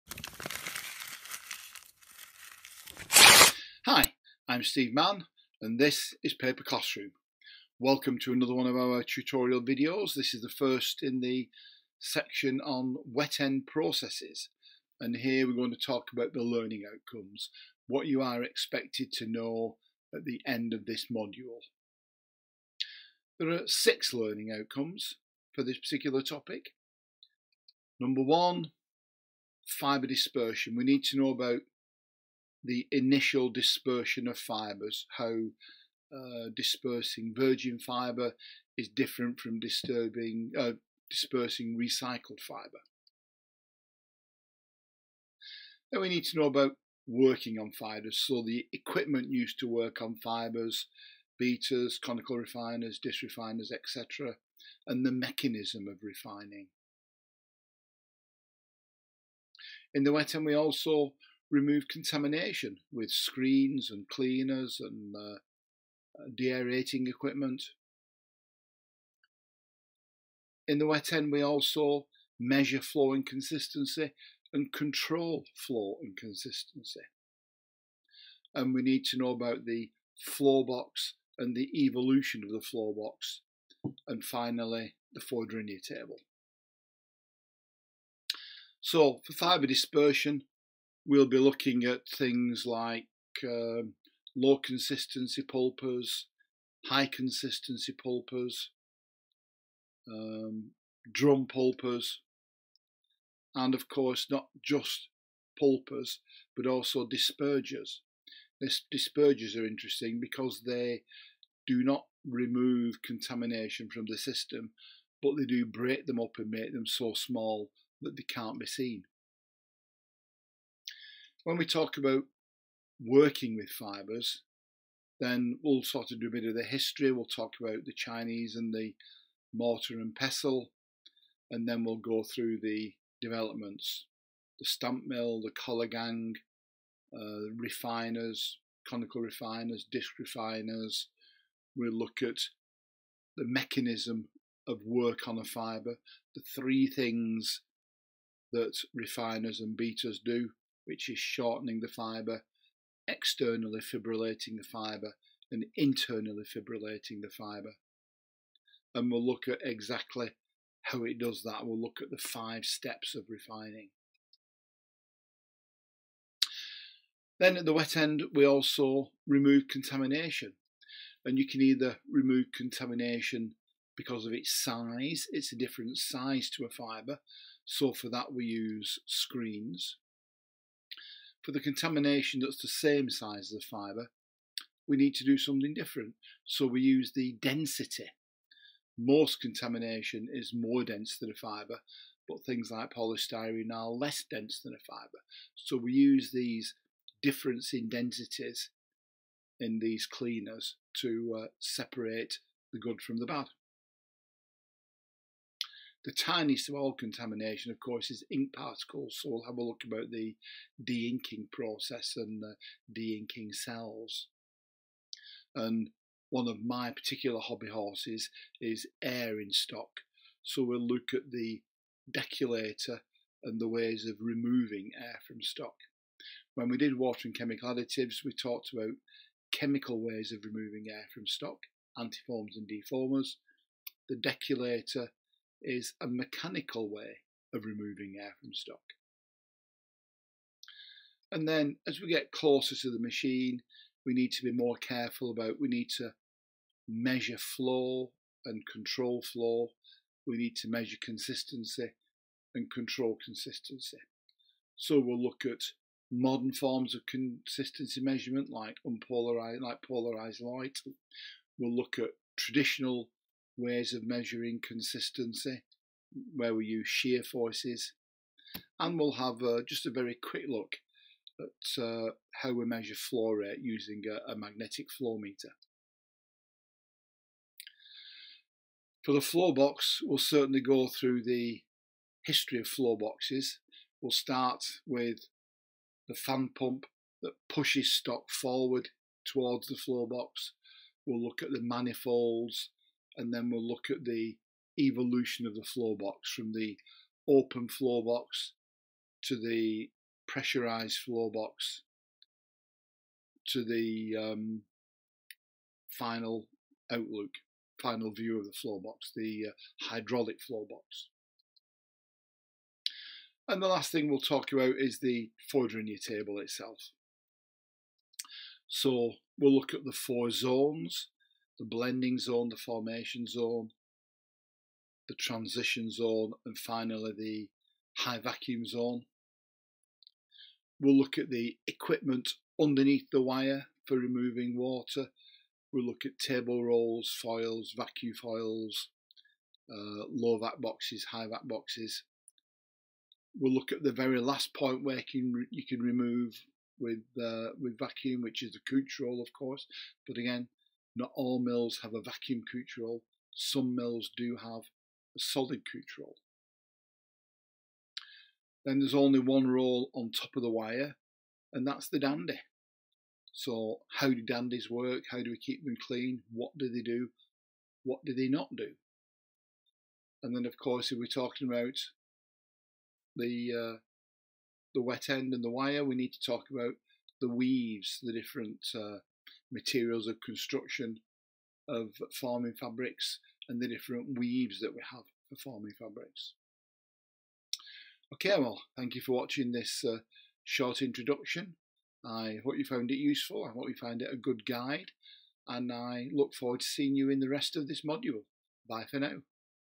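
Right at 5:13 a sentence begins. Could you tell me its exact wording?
And the last thing we'll talk about is the Fourdrinier table itself.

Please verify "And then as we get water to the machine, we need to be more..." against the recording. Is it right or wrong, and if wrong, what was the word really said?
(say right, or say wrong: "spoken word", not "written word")
wrong: "closer", not "water".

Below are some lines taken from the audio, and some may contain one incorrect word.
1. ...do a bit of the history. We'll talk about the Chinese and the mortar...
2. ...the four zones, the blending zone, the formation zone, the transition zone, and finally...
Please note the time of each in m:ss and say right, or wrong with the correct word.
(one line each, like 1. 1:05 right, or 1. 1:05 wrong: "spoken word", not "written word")
1. 2:06 right
2. 5:19 right.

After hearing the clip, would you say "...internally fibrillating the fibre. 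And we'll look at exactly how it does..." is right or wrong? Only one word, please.
right.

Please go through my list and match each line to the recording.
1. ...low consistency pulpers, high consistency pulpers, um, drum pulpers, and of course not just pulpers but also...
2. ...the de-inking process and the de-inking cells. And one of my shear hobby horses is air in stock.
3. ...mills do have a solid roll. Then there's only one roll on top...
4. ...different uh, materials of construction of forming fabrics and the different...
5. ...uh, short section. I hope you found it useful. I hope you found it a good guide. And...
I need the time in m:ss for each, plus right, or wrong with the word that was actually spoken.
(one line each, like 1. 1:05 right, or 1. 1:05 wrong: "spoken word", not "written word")
1. 1:34 right
2. 3:30 wrong: "particular", not "shear"
3. 5:53 right
4. 6:18 right
5. 6:29 wrong: "introduction", not "section".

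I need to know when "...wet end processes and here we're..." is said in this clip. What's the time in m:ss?
0:13.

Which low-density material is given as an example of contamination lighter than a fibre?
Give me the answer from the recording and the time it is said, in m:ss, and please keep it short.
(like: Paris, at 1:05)
Polystyrene, at 3:12.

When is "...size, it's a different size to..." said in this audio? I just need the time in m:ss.
2:54.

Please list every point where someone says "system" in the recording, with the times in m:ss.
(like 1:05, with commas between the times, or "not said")
1:54.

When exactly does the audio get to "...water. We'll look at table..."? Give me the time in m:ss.
5:34.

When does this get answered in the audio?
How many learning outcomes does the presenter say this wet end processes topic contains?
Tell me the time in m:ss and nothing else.
0:23.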